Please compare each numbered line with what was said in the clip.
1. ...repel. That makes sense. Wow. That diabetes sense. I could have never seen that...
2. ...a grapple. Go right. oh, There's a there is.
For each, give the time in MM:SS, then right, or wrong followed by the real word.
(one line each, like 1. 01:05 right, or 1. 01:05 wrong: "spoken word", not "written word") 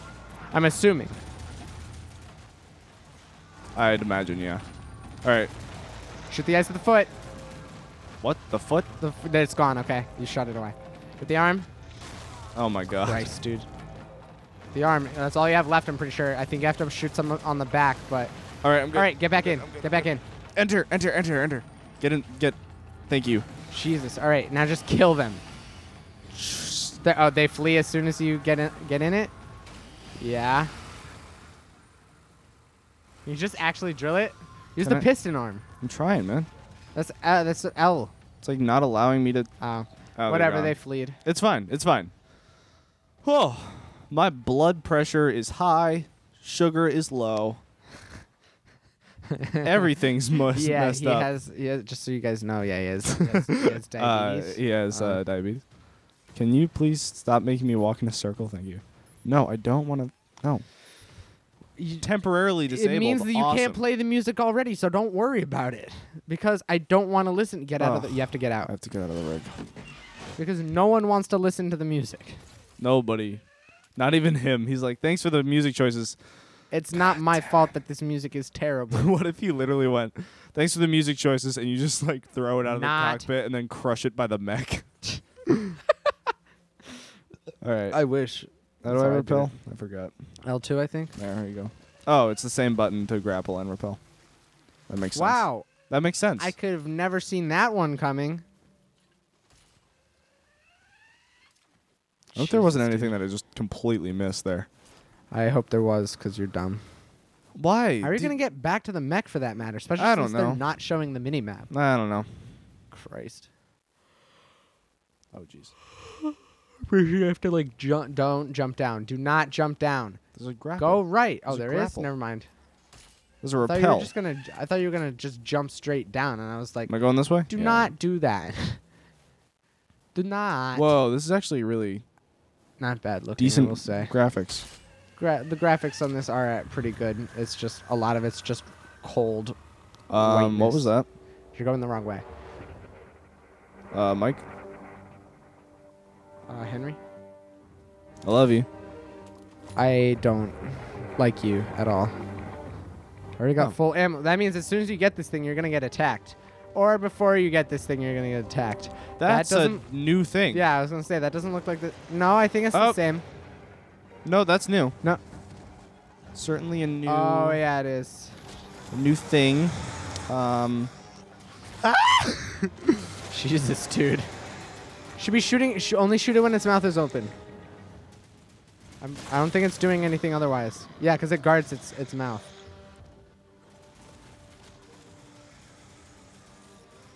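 1. 01:33 wrong: "makes", not "diabetes"
2. 02:00 right.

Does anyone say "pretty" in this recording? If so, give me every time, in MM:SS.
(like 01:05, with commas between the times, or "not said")
00:15, 02:16.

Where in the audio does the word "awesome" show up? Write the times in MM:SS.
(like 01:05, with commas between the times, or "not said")
01:03.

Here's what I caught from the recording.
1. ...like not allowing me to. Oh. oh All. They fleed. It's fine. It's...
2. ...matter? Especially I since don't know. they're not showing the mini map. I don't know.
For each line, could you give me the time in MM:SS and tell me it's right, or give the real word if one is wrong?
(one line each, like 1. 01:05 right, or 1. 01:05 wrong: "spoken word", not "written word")
1. 00:38 wrong: "Whatever", not "All"
2. 01:49 right.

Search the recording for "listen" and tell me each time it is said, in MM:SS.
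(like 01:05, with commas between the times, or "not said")
01:07, 01:11.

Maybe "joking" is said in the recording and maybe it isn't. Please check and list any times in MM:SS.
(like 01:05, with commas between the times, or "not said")
not said.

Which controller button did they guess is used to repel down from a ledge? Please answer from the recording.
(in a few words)
L2.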